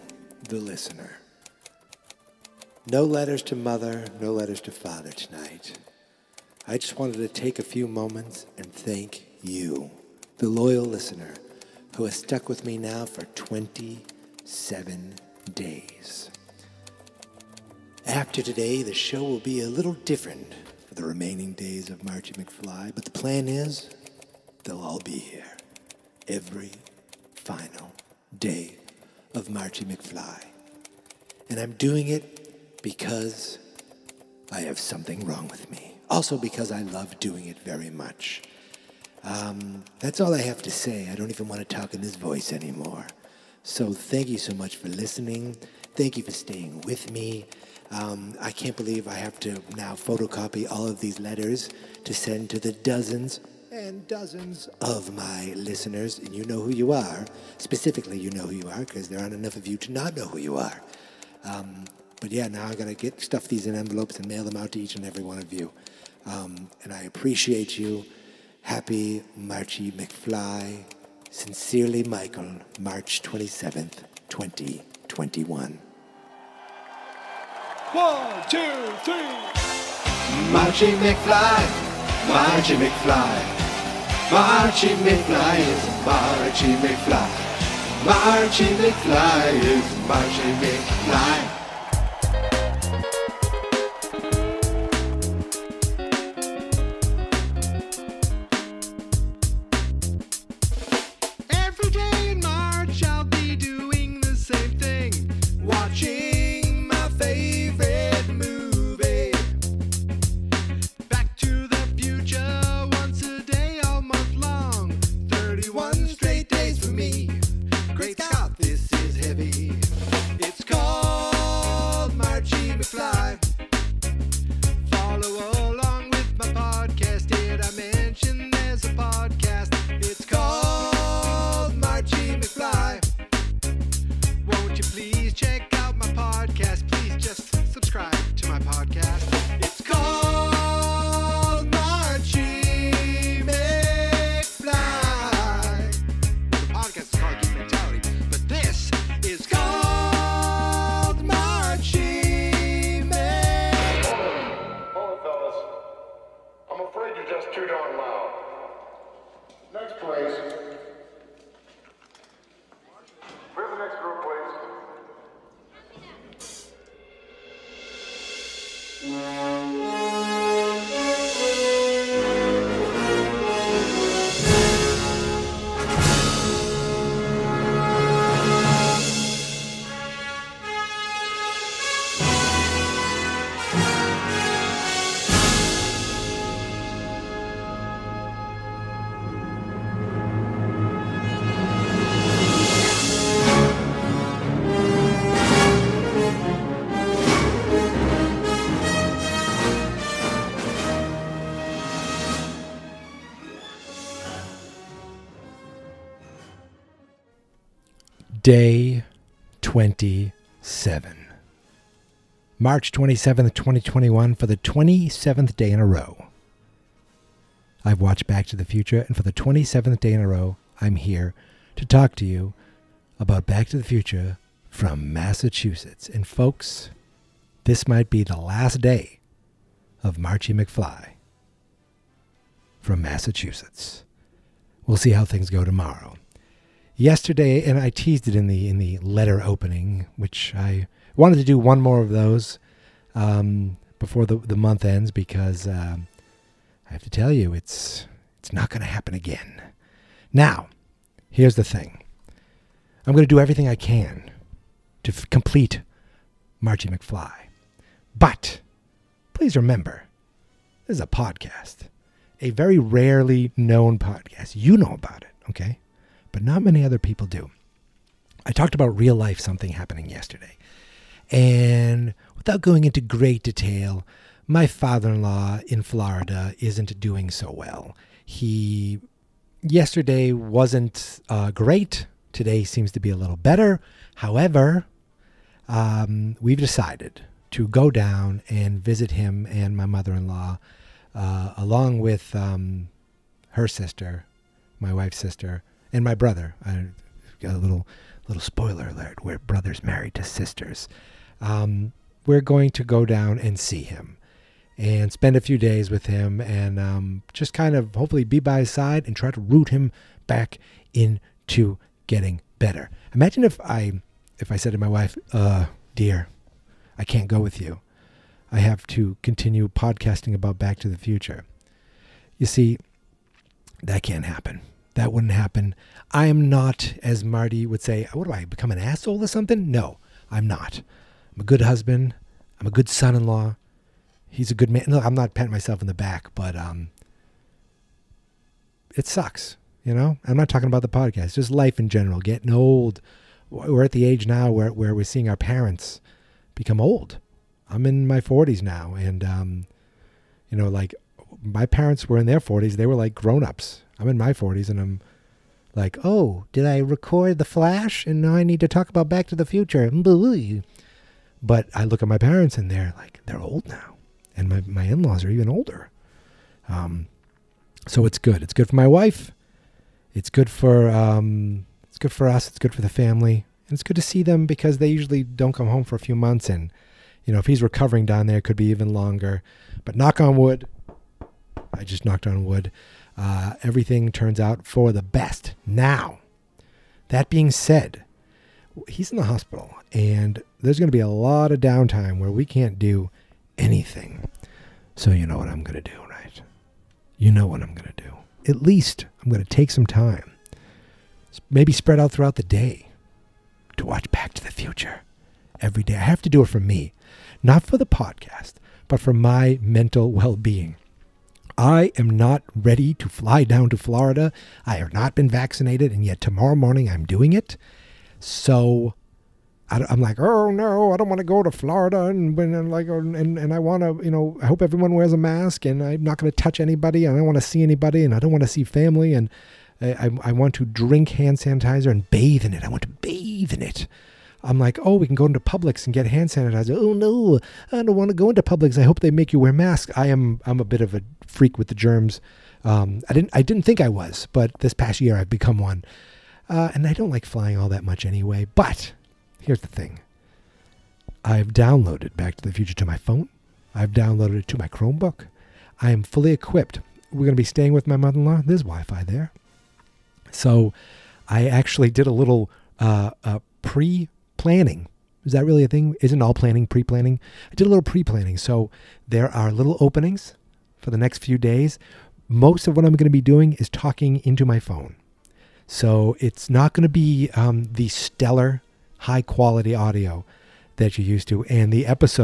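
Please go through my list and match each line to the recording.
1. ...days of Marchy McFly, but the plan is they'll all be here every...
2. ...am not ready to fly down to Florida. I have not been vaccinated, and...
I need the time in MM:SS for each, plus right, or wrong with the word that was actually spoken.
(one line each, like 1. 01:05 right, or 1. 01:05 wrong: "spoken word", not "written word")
1. 00:21 right
2. 06:51 right.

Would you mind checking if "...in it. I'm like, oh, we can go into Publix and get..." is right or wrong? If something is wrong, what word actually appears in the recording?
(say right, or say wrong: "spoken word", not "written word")
right.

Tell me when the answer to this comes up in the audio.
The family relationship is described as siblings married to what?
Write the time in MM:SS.
05:00.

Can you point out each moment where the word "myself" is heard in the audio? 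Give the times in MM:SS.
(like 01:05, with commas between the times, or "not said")
05:35.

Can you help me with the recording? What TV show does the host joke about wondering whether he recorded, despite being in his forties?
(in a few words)
The Flash.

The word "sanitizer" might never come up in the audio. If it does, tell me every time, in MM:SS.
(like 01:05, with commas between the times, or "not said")
07:11, 07:16.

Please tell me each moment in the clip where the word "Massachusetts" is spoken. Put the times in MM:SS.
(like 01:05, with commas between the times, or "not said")
03:45, 03:53.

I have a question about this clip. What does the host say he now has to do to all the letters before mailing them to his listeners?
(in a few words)
photocopy.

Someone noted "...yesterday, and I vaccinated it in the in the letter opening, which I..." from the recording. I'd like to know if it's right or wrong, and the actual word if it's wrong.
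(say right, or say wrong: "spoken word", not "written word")
wrong: "teased", not "vaccinated".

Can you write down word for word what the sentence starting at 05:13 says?
Imagine if I if I said to my wife, uh, dear, I can't go with you.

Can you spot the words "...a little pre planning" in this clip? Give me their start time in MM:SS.
07:47.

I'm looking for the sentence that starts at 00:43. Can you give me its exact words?
So thank you so much for listening.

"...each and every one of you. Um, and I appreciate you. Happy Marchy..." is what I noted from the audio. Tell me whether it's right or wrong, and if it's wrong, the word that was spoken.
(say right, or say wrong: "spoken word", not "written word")
right.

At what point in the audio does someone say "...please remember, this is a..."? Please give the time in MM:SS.
04:19.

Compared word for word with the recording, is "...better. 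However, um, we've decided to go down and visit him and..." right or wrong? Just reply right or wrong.
right.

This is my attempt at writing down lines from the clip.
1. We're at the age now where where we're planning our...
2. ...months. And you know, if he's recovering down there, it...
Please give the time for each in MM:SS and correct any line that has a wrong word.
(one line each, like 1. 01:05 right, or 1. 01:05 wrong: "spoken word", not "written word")
1. 05:43 wrong: "seeing", not "planning"
2. 06:16 right.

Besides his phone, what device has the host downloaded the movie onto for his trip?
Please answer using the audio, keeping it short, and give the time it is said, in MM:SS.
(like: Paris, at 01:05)
Chromebook, at 07:34.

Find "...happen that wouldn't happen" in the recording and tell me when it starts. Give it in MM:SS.
05:24.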